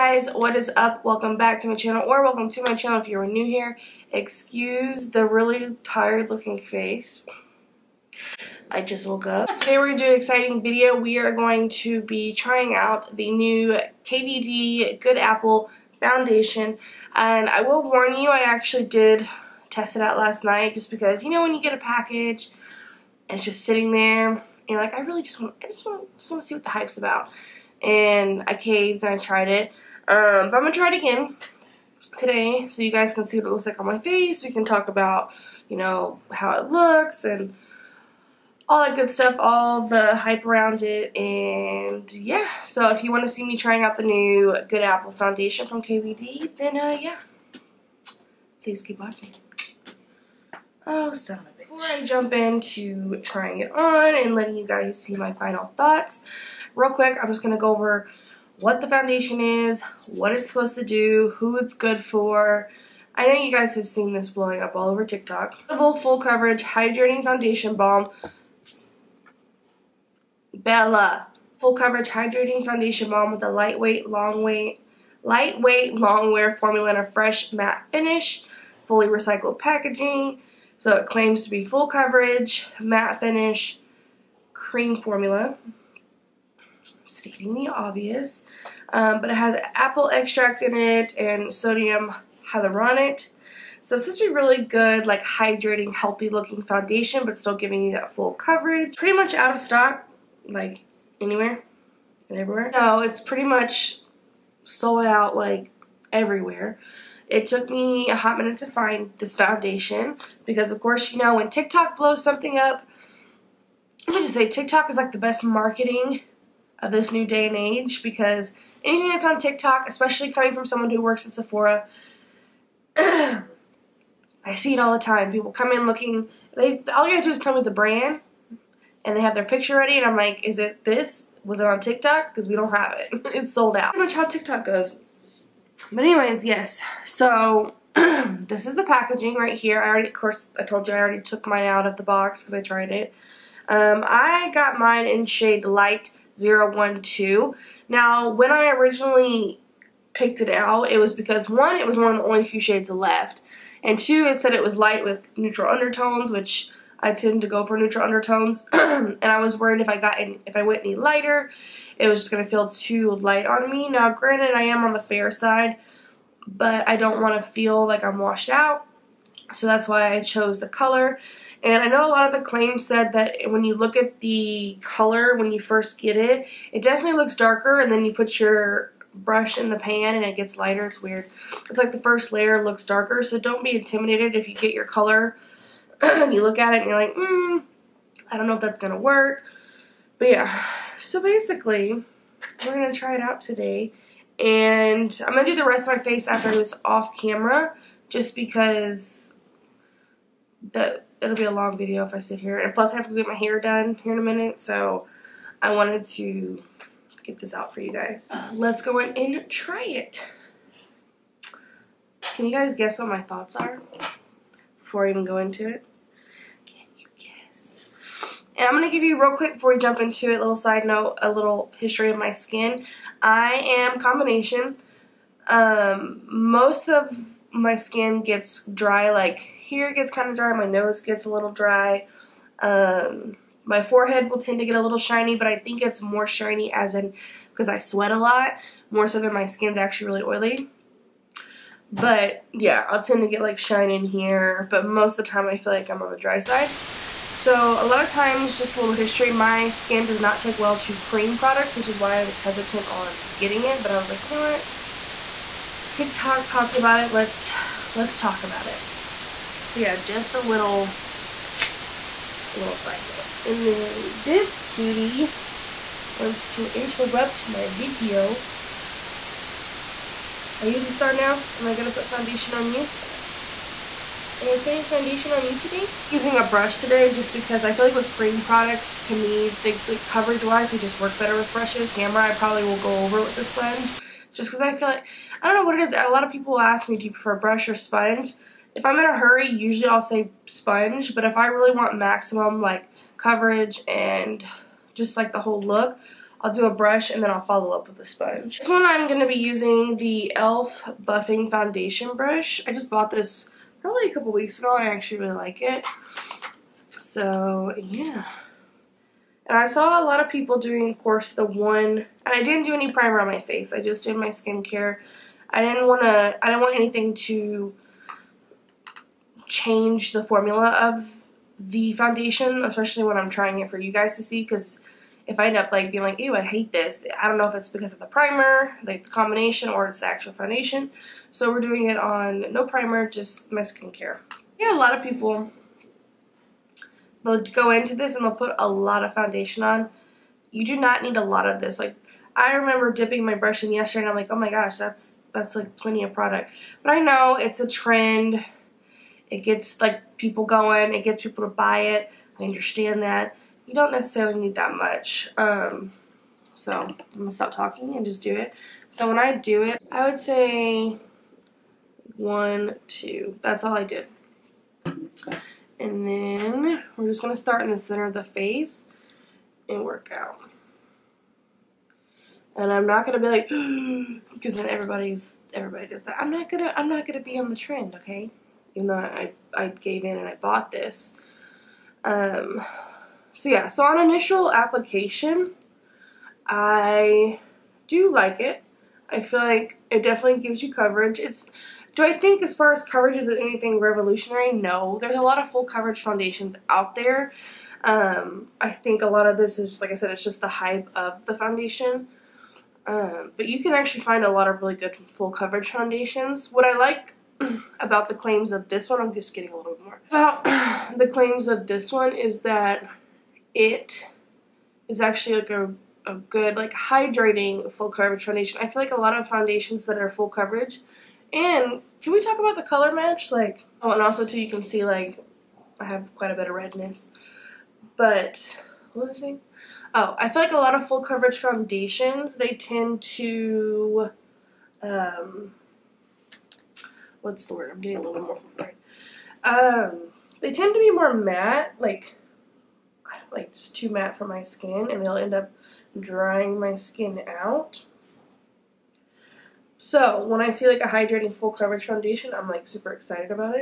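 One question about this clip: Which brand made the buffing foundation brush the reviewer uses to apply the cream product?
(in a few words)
e.l.f.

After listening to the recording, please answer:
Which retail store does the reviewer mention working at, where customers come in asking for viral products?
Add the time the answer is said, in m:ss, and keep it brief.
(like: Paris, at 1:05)
Sephora, at 2:01.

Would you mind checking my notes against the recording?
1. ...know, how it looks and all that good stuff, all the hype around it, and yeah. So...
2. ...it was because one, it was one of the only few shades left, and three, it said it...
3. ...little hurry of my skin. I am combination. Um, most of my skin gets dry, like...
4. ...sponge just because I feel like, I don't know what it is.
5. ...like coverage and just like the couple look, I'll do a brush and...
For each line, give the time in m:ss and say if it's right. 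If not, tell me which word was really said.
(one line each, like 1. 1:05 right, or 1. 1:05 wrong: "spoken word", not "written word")
1. 0:35 right
2. 2:30 wrong: "two", not "three"
3. 3:41 wrong: "history", not "hurry"
4. 4:43 right
5. 4:52 wrong: "whole", not "couple".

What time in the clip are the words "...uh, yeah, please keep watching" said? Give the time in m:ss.
0:46.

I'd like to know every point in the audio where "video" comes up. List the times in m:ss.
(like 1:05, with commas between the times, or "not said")
0:10, 3:21, 4:27.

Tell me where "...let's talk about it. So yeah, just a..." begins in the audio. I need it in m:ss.
4:17.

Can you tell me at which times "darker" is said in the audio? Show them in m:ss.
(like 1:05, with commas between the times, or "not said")
2:57, 3:02.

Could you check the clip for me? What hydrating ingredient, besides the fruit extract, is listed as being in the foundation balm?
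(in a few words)
Sodium hyaluronate.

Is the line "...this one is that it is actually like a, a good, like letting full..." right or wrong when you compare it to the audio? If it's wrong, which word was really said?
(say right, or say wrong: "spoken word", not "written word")
wrong: "hydrating", not "letting".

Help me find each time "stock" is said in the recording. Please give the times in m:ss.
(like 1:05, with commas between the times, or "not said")
1:39.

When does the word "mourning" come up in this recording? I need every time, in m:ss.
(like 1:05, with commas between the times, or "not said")
not said.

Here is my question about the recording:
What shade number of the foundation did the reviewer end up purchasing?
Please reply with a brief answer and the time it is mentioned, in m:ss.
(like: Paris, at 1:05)
012, at 2:25.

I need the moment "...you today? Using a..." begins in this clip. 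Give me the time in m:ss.
4:35.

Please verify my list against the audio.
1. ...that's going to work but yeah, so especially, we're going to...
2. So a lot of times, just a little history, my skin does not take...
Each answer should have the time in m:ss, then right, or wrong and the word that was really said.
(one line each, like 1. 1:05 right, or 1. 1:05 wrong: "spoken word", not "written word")
1. 3:08 wrong: "basically", not "especially"
2. 4:07 right.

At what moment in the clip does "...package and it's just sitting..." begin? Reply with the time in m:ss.
0:21.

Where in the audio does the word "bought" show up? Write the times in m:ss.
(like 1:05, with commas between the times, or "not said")
5:02, 6:20.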